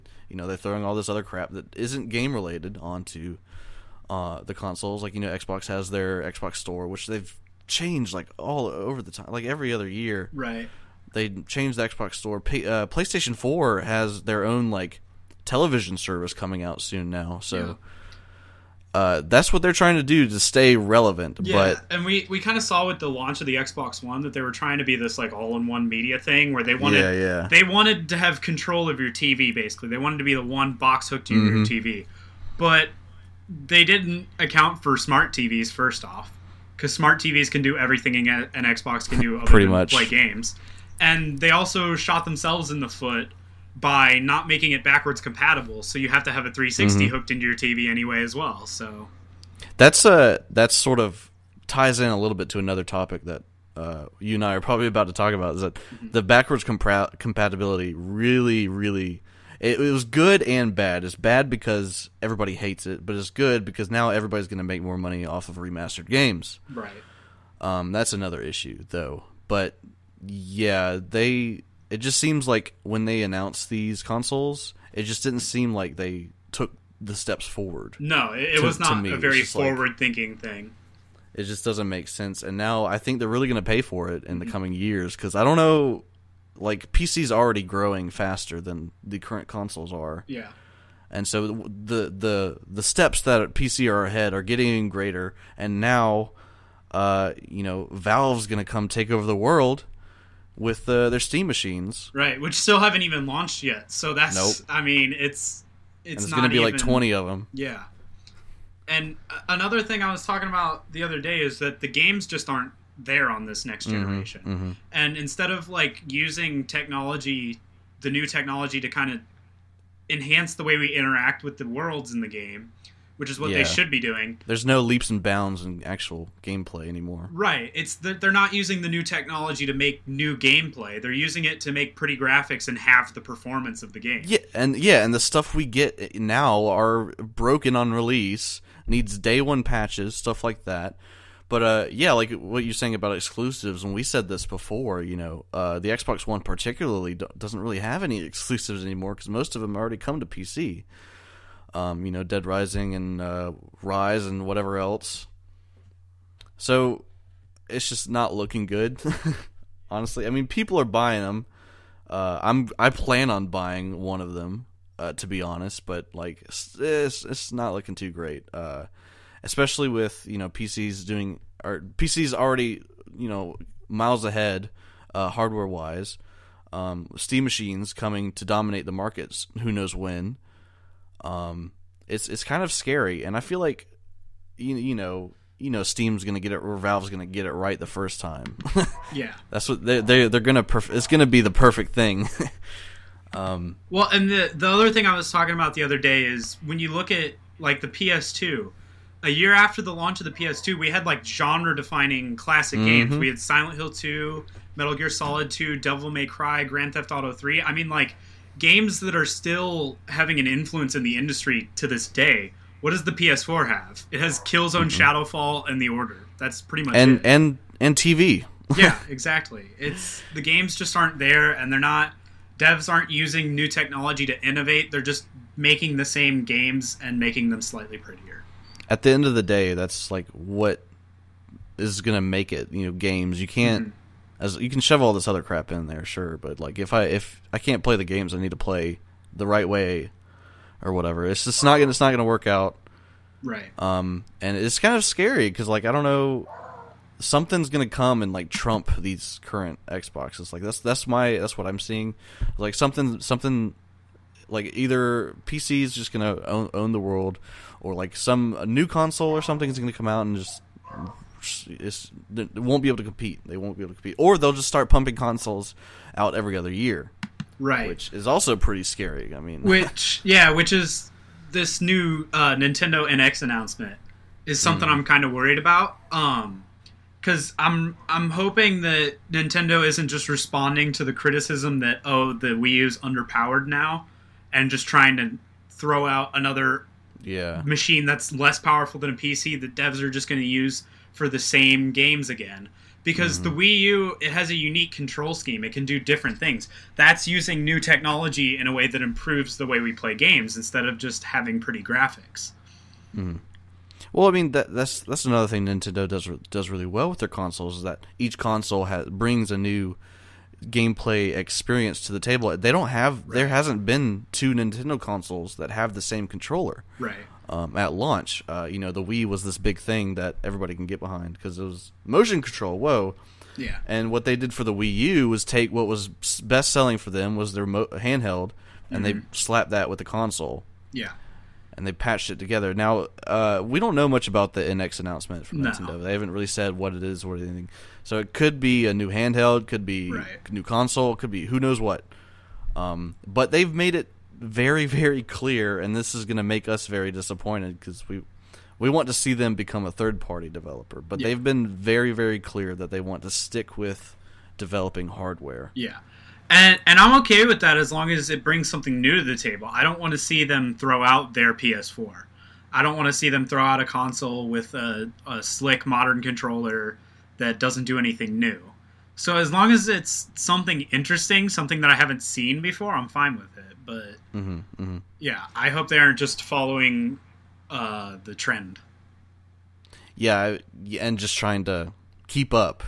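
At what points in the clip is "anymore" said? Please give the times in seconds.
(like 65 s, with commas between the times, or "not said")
126 s, 148 s.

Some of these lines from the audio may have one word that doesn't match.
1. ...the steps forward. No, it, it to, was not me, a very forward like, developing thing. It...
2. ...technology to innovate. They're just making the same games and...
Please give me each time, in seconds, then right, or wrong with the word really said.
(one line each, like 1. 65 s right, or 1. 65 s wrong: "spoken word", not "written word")
1. 76 s wrong: "thinking", not "developing"
2. 223 s right.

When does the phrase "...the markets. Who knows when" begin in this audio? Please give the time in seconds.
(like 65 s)
178 s.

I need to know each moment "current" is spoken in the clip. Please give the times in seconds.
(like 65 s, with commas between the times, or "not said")
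89 s, 249 s.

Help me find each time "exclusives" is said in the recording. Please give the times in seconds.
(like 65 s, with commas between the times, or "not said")
143 s, 148 s.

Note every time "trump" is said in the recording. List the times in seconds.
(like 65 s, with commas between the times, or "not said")
248 s.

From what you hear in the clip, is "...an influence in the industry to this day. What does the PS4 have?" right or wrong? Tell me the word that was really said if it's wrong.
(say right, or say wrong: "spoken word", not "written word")
right.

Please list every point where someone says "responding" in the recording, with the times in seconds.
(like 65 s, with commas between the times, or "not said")
280 s.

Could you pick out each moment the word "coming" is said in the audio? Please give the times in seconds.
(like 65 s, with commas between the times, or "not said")
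16 s, 84 s, 177 s.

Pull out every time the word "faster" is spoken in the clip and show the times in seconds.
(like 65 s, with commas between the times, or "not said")
88 s.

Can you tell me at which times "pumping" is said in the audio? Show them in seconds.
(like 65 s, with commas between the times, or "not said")
264 s.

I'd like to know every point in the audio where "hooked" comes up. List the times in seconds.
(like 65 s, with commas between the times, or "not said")
31 s, 47 s.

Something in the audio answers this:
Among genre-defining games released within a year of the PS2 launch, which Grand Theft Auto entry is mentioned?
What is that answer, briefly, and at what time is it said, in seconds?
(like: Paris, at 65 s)
Grand Theft Auto 3, at 206 s.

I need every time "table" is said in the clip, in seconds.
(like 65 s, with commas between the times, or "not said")
312 s, 359 s.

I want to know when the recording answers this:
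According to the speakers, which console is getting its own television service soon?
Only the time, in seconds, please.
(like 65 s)
12 s.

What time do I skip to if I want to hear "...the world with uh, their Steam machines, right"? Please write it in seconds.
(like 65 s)
99 s.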